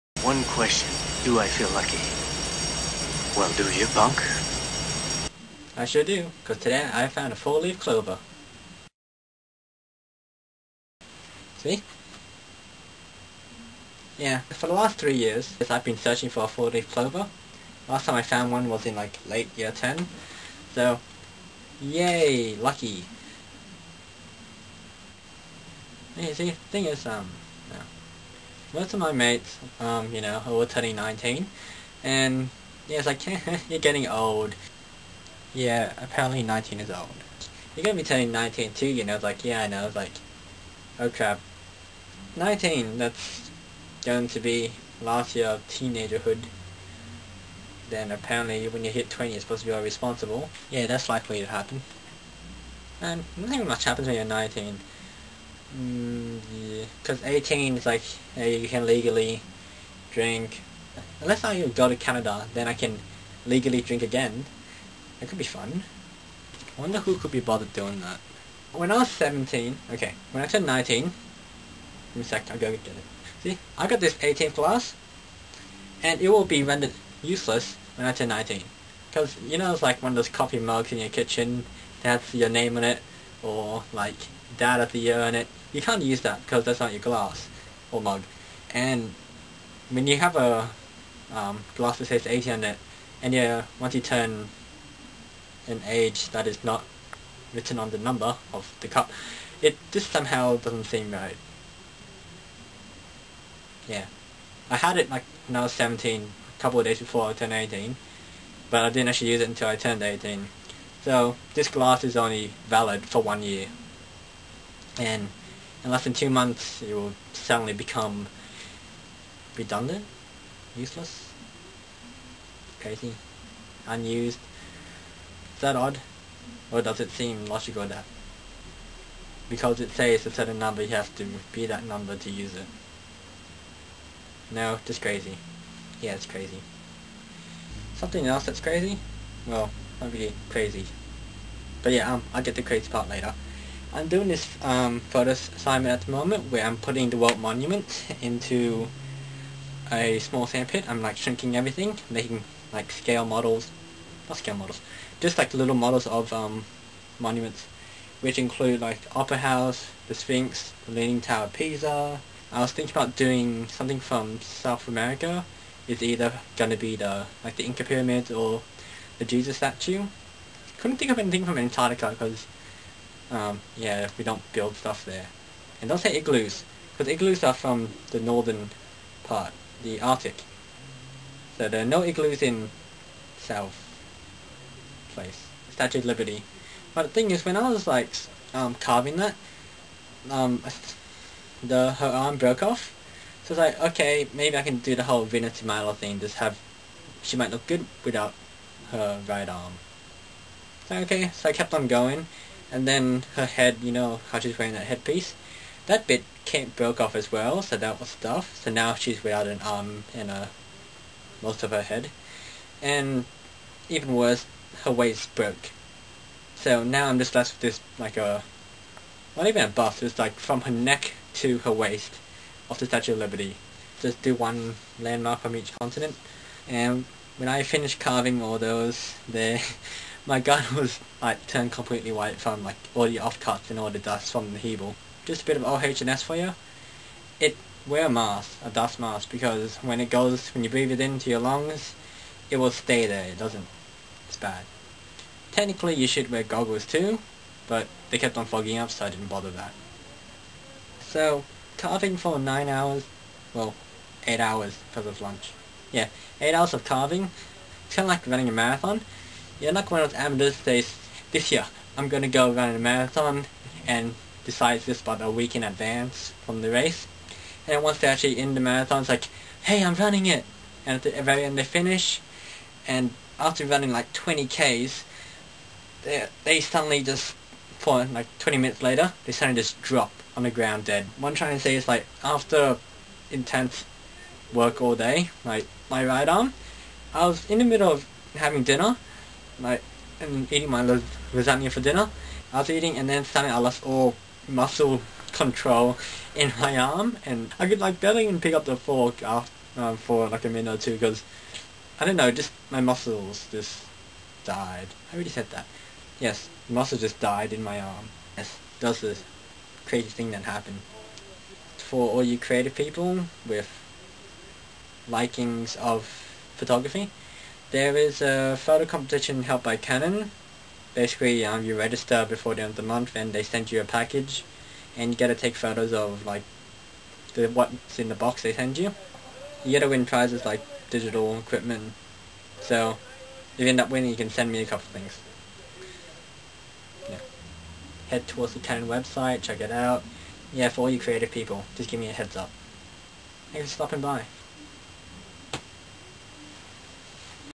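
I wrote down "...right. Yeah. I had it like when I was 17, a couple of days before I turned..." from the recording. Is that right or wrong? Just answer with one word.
right.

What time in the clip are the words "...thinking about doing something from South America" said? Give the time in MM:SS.
02:42.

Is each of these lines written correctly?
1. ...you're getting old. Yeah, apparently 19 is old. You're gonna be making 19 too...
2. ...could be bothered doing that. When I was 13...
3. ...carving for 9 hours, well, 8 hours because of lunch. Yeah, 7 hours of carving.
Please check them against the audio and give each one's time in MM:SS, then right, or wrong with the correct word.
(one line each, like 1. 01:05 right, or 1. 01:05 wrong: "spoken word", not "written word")
1. 00:33 wrong: "turning", not "making"
2. 01:07 wrong: "17", not "13"
3. 04:11 wrong: "8", not "7".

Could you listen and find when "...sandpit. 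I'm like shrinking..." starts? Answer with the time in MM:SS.
02:30.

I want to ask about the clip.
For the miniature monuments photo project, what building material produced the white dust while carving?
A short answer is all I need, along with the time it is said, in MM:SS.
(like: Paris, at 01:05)
Hebel, at 03:54.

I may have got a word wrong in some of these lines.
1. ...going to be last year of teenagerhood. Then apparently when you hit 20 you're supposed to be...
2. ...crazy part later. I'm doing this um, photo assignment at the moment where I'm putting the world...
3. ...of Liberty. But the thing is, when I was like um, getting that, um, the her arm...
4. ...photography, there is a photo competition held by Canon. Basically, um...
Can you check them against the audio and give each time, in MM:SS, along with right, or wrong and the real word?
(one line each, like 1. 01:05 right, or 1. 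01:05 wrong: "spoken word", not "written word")
1. 00:44 right
2. 02:22 right
3. 03:05 wrong: "carving", not "getting"
4. 05:16 right.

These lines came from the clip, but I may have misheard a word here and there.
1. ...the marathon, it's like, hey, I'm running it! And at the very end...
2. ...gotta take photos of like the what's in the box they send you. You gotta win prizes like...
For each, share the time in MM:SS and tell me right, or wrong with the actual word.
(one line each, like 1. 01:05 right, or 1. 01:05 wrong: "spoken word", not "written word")
1. 04:28 right
2. 05:25 right.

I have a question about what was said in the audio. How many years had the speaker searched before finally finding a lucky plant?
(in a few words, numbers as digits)
3.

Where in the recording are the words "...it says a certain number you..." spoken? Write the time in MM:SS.
02:09.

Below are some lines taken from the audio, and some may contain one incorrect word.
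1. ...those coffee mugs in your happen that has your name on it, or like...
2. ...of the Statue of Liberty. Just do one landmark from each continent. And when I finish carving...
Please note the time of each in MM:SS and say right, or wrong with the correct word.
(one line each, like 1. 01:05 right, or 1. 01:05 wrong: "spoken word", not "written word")
1. 01:20 wrong: "kitchen", not "happen"
2. 03:42 right.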